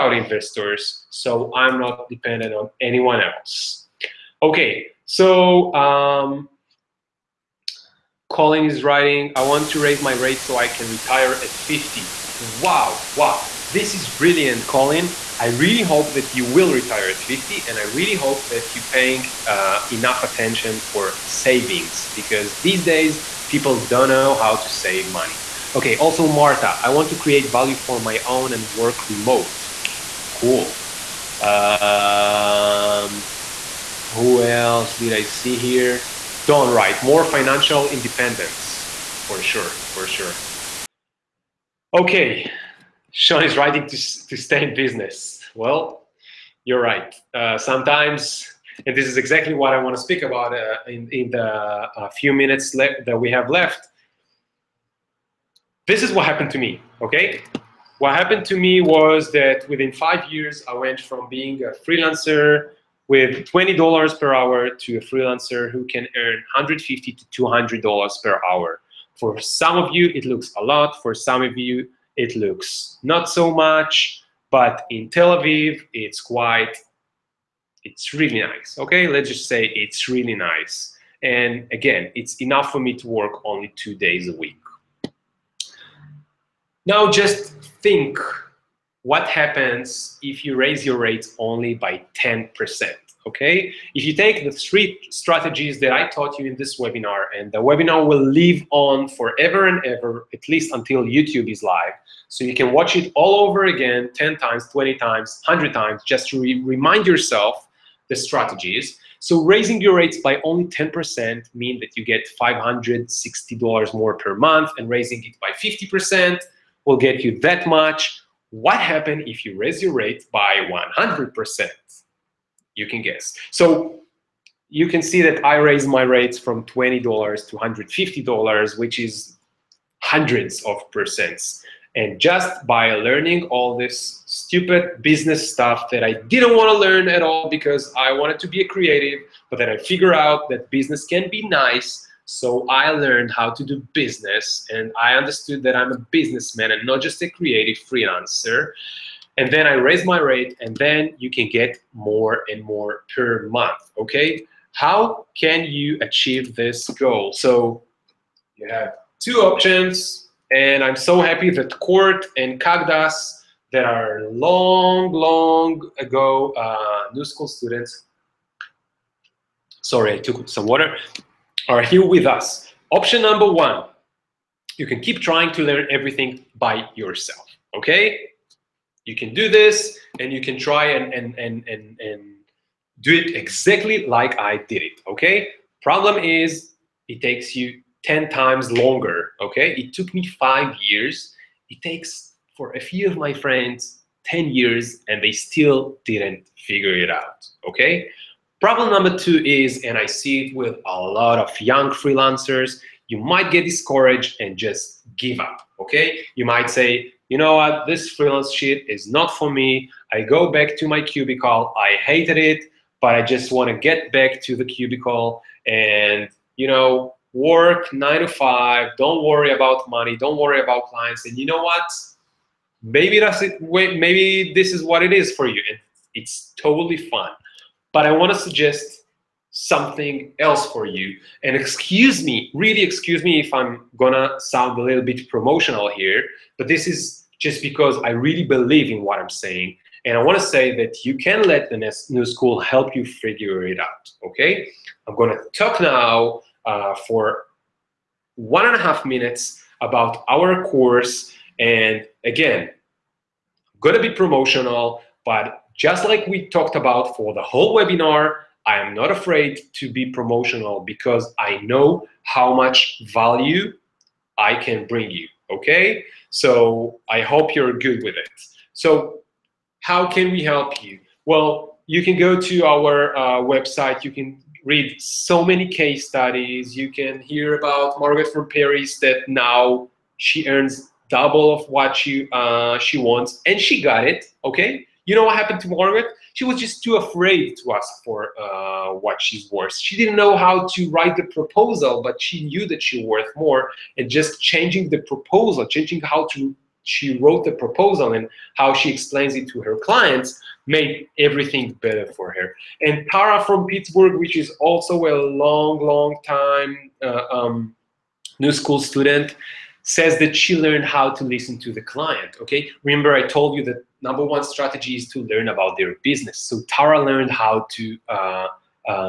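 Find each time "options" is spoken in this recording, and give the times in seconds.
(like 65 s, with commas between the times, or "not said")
159 s, 172 s.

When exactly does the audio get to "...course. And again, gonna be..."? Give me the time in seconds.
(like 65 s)
250 s.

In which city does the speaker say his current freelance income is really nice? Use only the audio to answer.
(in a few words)
Tel Aviv.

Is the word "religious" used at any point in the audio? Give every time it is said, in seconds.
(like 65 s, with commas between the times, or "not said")
not said.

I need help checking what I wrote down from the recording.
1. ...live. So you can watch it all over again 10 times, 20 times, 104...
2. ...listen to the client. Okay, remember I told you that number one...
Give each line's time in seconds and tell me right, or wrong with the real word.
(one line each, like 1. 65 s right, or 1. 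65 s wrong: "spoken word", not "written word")
1. 101 s wrong: "100", not "104"
2. 311 s right.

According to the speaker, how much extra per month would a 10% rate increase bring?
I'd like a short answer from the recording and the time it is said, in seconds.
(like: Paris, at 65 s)
$560, at 112 s.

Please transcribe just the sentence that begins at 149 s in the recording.
And then I raised my rate and then you can get more and more per month, okay?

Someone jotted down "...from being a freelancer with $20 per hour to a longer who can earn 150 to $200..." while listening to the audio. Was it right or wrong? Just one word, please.
wrong.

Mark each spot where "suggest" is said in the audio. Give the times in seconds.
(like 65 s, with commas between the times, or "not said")
228 s.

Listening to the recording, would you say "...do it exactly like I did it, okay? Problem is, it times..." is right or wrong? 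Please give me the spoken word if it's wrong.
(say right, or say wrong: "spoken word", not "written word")
wrong: "takes", not "times".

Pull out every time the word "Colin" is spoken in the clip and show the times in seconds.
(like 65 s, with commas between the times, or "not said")
8 s, 14 s.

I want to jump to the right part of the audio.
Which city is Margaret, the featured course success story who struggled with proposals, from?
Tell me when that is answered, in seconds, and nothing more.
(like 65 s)
278 s.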